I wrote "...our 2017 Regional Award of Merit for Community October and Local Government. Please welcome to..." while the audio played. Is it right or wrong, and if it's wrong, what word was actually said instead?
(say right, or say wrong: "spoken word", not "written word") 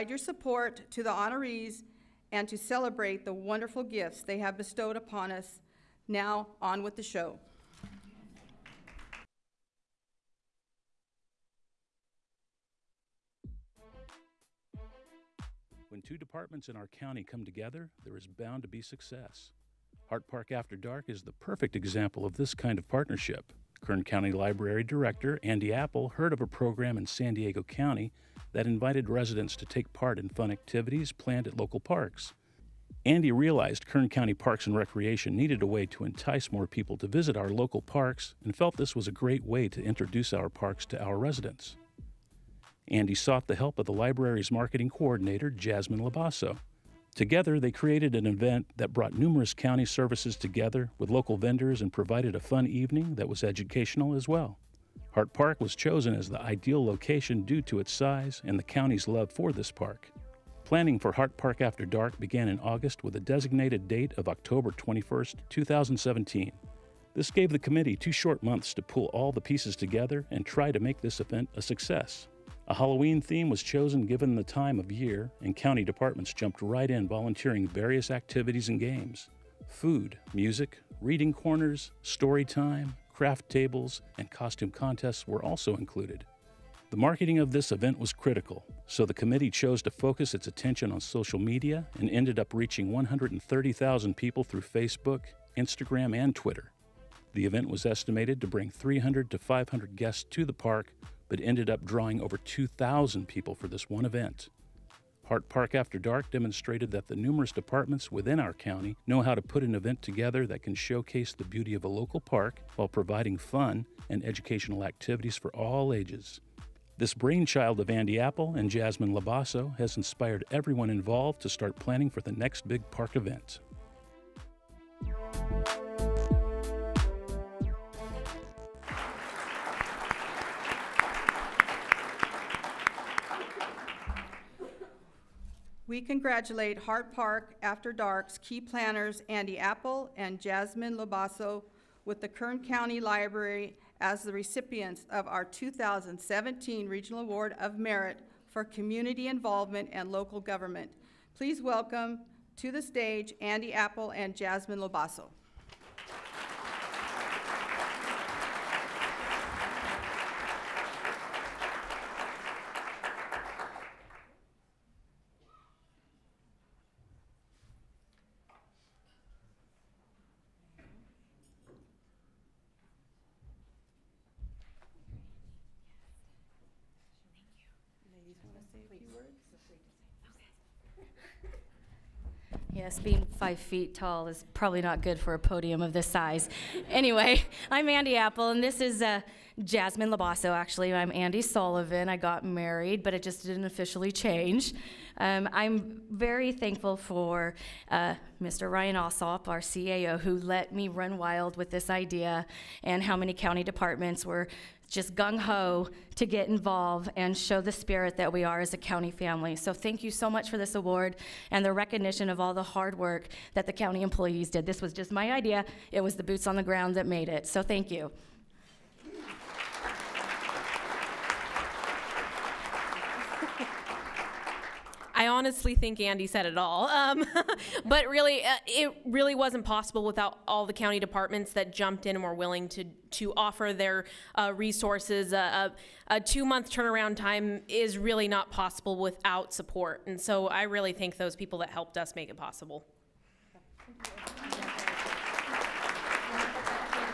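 wrong: "Involvement", not "October".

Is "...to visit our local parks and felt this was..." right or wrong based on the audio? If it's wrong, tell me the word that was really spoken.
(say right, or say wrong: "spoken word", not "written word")
right.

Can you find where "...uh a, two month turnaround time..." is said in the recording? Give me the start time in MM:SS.
03:55.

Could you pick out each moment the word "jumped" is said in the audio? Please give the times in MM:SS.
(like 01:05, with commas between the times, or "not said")
01:16, 03:51.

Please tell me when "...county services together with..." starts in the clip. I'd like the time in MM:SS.
00:49.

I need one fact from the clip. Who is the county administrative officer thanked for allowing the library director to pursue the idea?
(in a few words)
Ryan Alsop.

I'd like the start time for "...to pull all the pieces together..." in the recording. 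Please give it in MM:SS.
01:08.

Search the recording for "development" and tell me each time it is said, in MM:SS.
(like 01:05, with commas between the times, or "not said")
not said.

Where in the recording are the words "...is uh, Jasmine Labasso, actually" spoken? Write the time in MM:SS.
03:08.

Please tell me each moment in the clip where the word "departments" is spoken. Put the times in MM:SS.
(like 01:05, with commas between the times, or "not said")
00:16, 01:15, 01:47, 03:23, 03:51.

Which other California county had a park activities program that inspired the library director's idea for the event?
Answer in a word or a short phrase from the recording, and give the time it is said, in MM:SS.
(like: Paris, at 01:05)
San Diego County, at 00:27.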